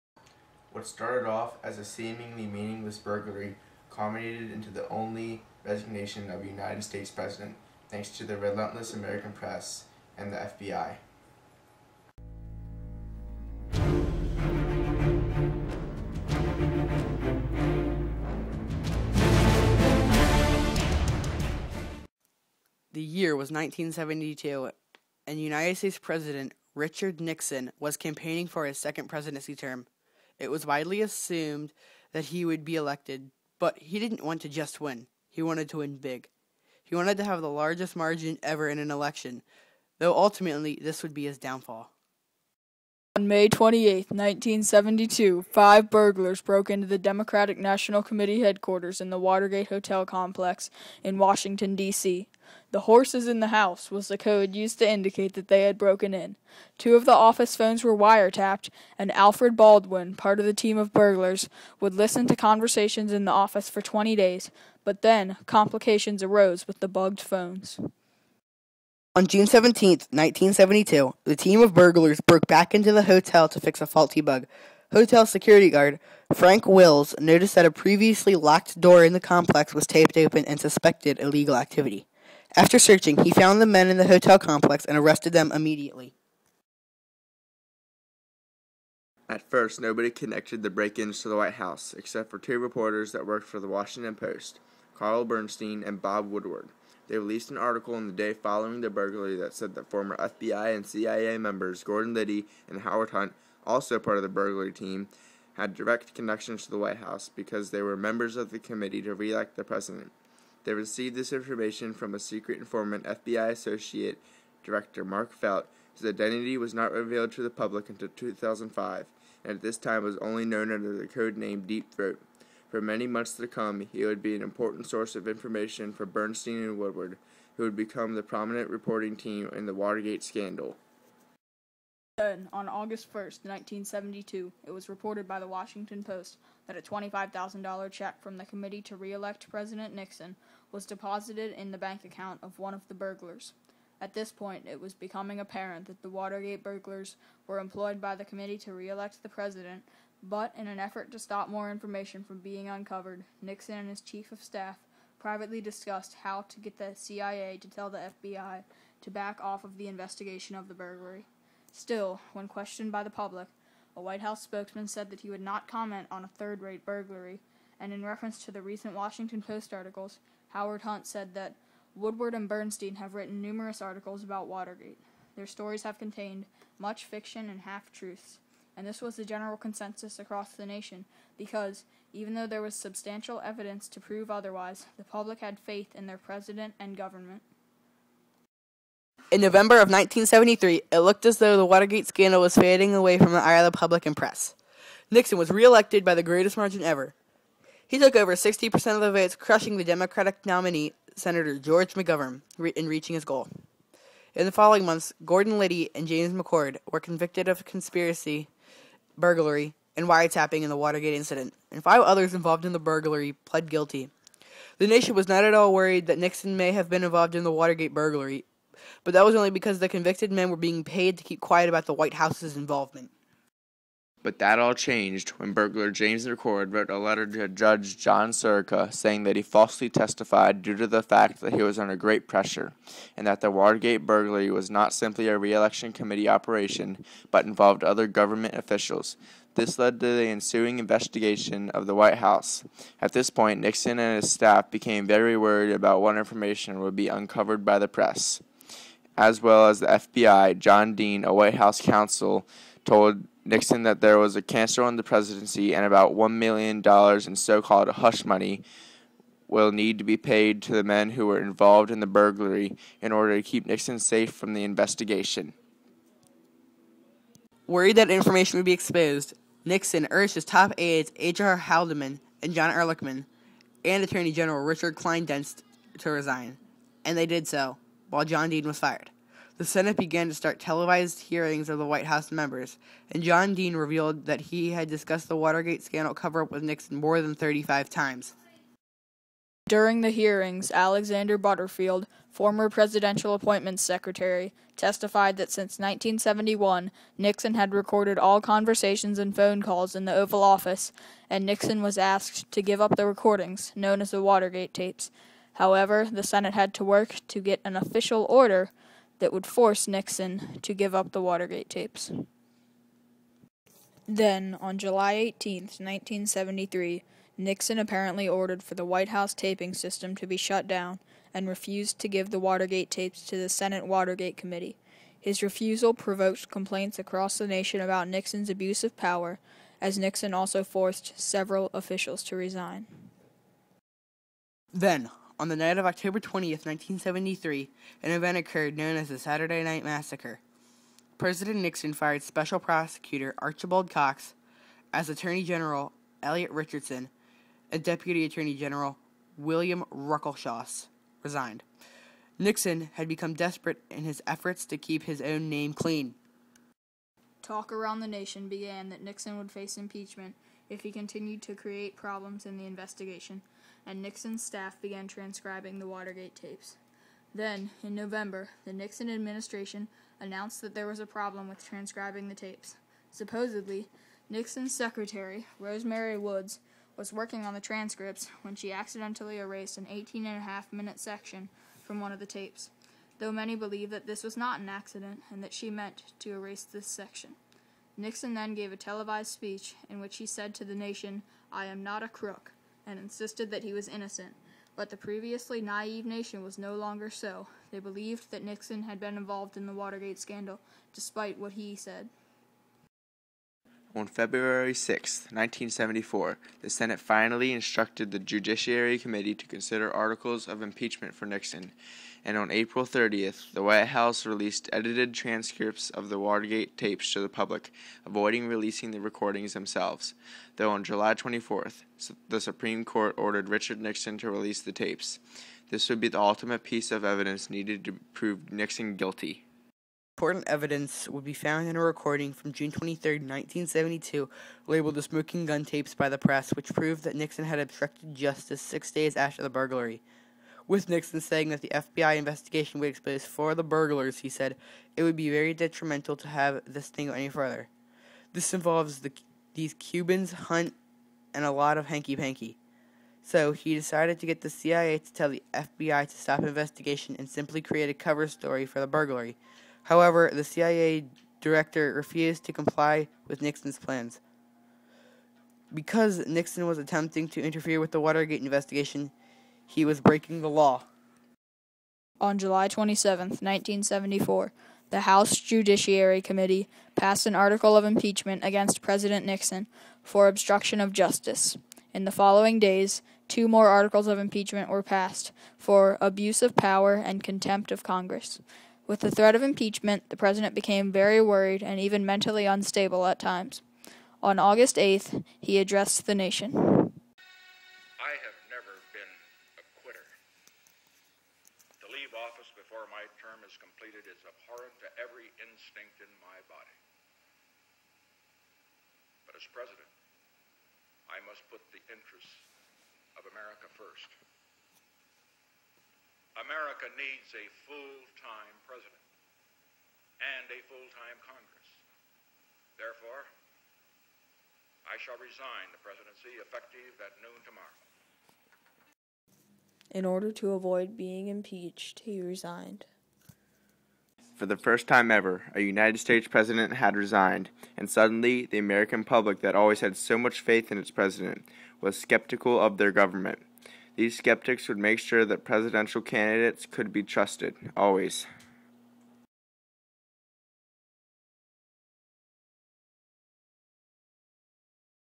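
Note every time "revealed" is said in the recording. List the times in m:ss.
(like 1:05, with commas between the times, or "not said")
1:56, 4:43.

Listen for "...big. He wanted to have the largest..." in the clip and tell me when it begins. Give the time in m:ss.
0:35.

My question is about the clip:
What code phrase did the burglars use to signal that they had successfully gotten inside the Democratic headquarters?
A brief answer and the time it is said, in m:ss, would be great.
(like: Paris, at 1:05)
The horses in the house, at 0:52.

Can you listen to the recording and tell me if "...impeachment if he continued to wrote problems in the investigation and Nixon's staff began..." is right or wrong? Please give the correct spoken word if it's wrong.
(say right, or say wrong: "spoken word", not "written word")
wrong: "create", not "wrote".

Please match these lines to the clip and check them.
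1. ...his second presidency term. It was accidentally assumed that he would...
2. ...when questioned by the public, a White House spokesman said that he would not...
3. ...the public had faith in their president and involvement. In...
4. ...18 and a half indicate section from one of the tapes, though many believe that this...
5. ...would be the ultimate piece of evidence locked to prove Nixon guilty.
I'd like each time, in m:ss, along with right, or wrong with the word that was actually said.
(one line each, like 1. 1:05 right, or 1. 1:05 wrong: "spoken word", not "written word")
1. 0:28 wrong: "widely", not "accidentally"
2. 2:42 right
3. 3:04 wrong: "government", not "involvement"
4. 6:19 wrong: "minute", not "indicate"
5. 7:05 wrong: "needed", not "locked".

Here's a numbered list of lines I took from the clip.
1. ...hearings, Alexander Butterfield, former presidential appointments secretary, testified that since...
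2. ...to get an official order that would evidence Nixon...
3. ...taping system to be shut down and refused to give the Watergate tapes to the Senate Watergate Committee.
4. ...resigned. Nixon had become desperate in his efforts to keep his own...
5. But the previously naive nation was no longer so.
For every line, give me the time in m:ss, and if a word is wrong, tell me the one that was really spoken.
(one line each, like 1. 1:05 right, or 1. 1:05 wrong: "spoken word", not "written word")
1. 4:50 right
2. 5:07 wrong: "force", not "evidence"
3. 5:19 right
4. 5:51 right
5. 6:34 right.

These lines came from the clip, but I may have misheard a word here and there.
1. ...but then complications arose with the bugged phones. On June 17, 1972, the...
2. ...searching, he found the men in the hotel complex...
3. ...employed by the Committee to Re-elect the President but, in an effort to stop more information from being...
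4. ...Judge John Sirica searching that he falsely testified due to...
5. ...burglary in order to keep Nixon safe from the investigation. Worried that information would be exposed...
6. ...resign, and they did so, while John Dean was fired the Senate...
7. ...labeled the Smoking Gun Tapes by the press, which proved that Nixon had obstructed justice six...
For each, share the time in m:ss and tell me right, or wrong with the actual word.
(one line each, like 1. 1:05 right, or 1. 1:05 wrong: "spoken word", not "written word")
1. 1:04 right
2. 1:22 right
3. 2:27 right
4. 3:47 wrong: "saying", not "searching"
5. 4:22 right
6. 4:36 right
7. 7:14 right.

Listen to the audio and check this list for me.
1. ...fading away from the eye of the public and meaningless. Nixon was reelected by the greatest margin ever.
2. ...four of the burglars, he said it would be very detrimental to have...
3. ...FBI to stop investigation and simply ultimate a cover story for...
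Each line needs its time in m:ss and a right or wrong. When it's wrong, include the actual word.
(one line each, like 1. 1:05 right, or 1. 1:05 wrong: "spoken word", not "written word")
1. 3:12 wrong: "press", not "meaningless"
2. 7:23 right
3. 7:35 wrong: "create", not "ultimate".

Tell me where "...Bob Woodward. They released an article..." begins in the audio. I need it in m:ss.
1:36.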